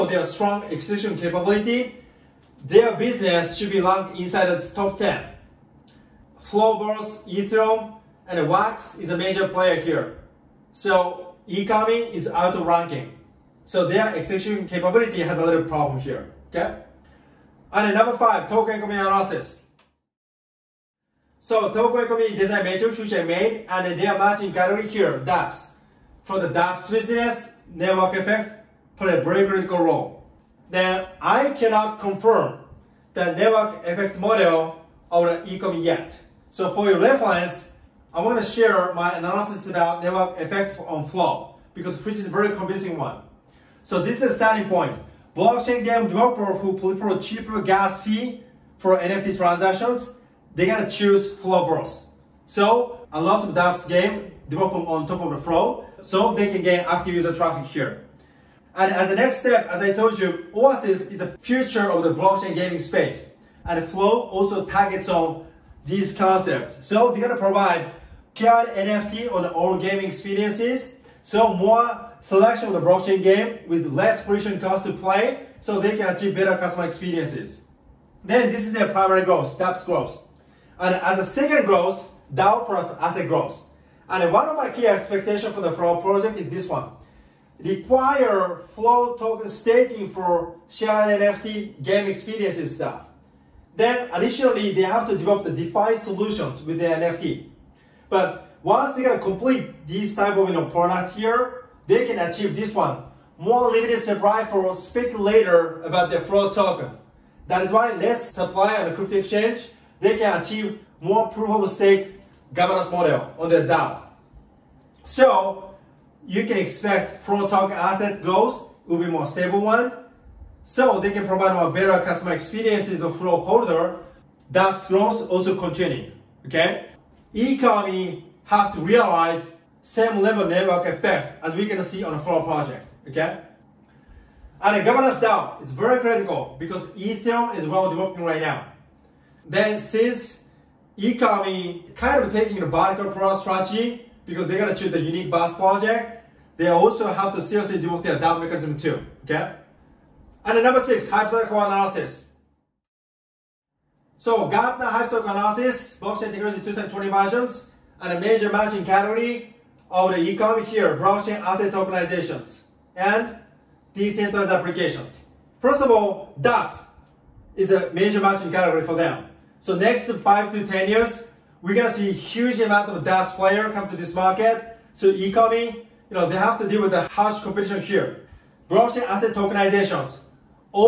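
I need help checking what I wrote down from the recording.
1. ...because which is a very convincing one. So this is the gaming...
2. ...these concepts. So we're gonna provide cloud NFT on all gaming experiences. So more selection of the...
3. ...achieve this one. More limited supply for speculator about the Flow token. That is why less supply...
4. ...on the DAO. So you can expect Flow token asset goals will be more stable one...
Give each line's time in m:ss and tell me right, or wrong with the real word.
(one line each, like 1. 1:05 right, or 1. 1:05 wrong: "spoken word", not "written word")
1. 0:41 wrong: "starting", not "gaming"
2. 1:05 right
3. 1:42 right
4. 1:53 right.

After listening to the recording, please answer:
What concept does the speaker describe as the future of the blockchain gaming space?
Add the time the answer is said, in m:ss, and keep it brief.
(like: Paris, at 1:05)
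Oasis, at 1:00.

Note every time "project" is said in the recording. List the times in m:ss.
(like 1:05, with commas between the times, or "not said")
1:26, 2:12, 2:25.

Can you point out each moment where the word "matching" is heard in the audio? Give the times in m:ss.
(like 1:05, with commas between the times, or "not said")
0:24, 2:38, 2:48.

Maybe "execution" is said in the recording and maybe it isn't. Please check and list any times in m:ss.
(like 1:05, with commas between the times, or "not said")
0:00, 0:14.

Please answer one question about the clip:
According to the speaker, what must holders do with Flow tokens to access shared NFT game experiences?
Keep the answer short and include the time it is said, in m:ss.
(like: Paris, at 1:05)
Staking, at 1:27.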